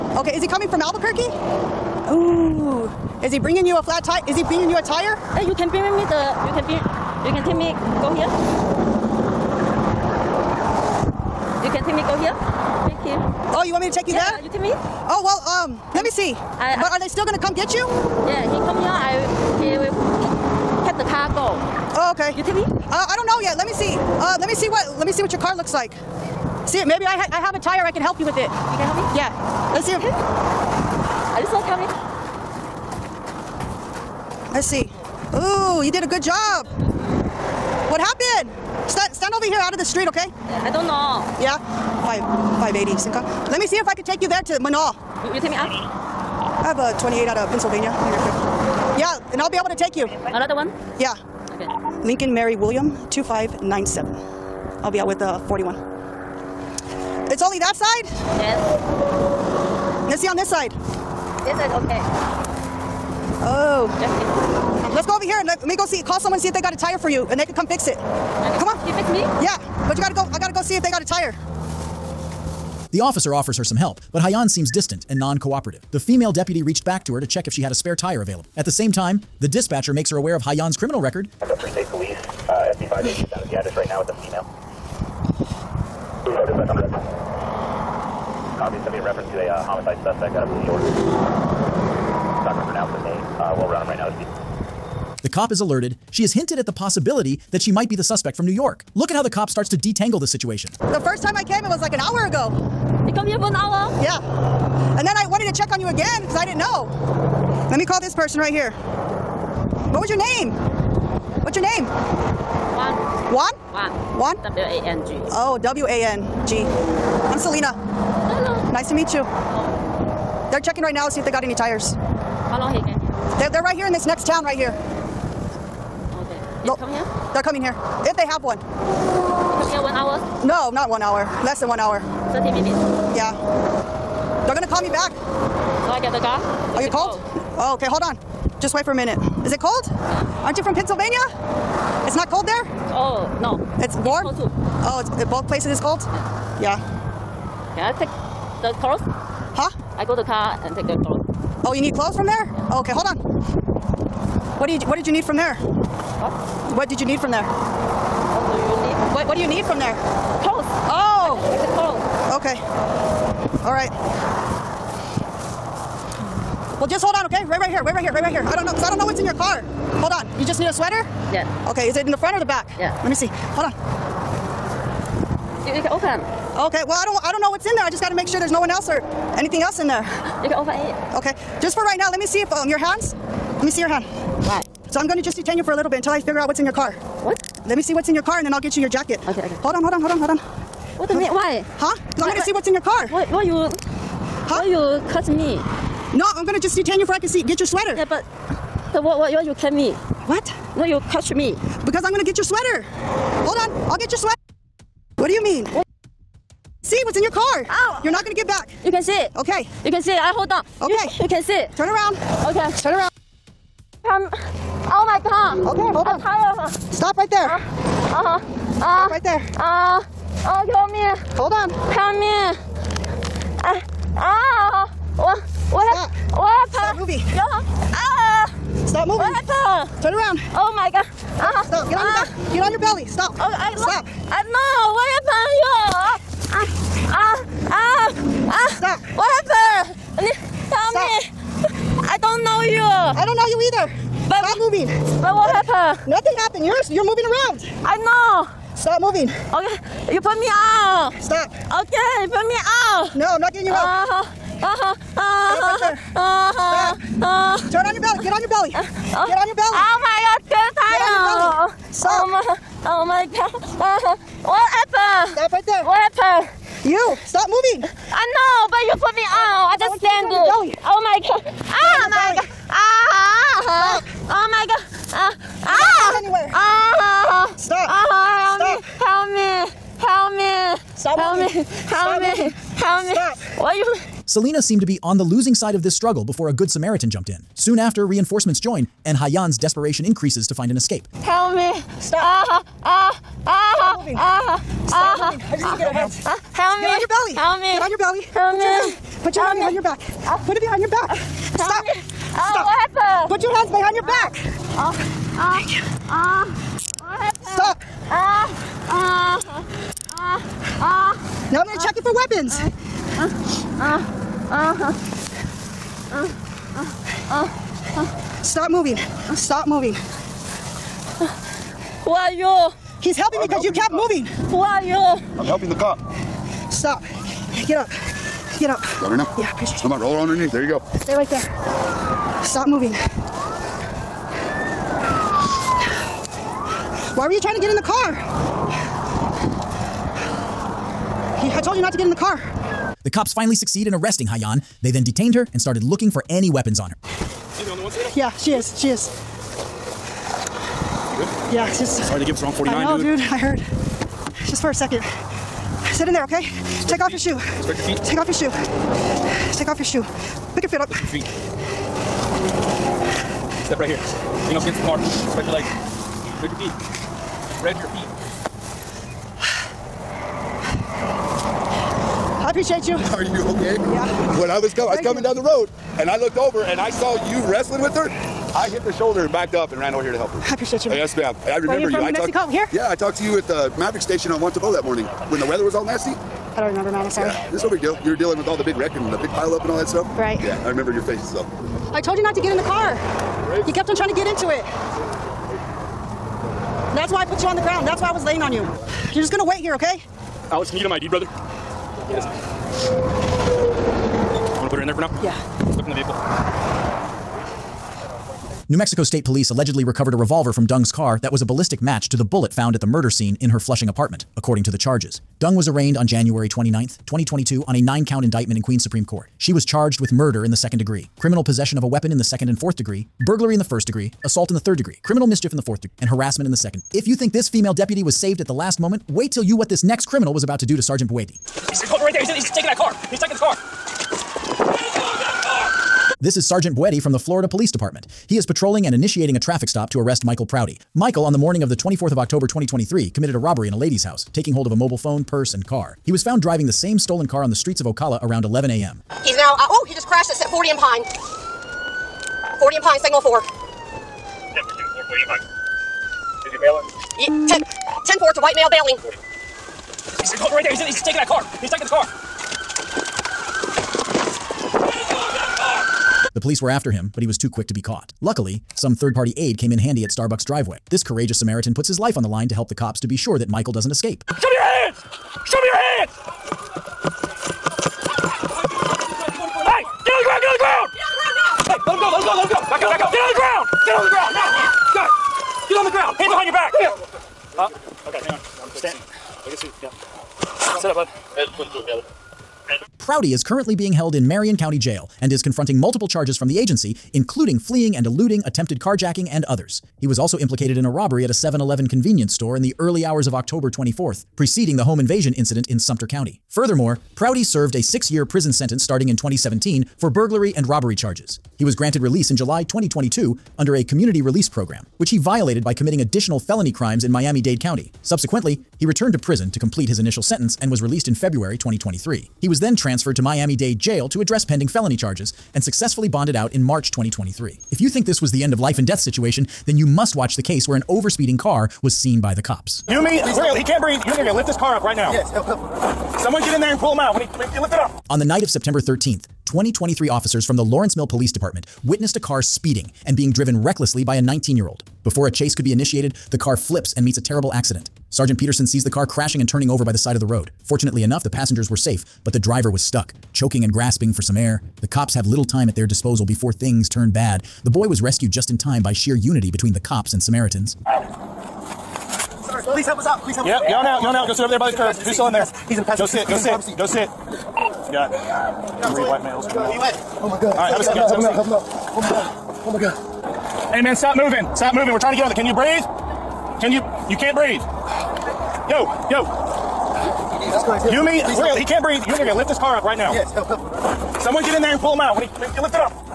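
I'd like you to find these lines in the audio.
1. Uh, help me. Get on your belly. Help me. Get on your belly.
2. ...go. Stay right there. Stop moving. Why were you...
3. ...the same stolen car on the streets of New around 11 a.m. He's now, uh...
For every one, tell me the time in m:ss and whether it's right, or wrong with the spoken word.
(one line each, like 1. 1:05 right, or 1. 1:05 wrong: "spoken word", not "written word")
1. 4:56 right
2. 5:30 right
3. 7:26 wrong: "Ocala", not "New".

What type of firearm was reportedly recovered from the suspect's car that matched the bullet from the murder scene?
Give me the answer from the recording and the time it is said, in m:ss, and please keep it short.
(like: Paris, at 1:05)
Revolver, at 6:50.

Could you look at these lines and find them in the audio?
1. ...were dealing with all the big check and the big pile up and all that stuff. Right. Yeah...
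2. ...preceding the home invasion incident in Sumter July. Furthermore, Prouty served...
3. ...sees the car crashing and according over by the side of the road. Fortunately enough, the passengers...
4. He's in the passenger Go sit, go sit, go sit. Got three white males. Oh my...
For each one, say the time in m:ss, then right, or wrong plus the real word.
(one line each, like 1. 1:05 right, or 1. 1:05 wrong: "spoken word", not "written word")
1. 6:28 wrong: "wreck", not "check"
2. 8:24 wrong: "County", not "July"
3. 9:08 wrong: "turning", not "according"
4. 9:25 right.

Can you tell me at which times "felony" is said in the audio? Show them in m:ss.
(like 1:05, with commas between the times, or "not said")
8:36, 8:44.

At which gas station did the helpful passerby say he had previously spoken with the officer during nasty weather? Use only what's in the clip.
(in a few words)
Maverick station.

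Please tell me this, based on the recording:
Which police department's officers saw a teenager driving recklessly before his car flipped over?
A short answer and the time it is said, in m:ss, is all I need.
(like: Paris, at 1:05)
Lawrenceville Police Department, at 9:00.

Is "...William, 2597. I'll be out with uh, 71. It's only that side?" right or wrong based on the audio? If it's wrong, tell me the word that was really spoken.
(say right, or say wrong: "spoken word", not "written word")
wrong: "41", not "71".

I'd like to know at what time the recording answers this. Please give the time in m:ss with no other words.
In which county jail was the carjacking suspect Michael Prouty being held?
8:14.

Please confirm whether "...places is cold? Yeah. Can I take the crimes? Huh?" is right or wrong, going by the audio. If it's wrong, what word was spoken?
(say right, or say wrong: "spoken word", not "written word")
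wrong: "clothes", not "crimes".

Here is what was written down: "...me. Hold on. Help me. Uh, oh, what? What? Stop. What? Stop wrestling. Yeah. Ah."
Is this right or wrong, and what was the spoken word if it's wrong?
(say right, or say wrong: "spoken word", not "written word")
wrong: "moving", not "wrestling".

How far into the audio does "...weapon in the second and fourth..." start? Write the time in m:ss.
7:01.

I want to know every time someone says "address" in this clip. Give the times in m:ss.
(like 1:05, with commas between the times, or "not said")
1:23, 8:44.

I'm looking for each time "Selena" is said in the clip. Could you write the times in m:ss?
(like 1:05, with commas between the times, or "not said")
1:57, 4:44, 5:47.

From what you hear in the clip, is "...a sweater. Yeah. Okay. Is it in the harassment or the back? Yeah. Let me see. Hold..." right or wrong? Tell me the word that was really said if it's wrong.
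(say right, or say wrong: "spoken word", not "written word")
wrong: "front", not "harassment".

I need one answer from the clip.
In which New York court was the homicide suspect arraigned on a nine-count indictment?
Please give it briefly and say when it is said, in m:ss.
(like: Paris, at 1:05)
Queens Supreme Court, at 6:58.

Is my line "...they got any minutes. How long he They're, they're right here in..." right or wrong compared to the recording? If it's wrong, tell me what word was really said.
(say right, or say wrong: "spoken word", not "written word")
wrong: "tires", not "minutes".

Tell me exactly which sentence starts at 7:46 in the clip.
The police were after him, but he was too quick to be caught.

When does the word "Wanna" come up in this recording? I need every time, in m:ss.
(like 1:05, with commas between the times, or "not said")
6:44.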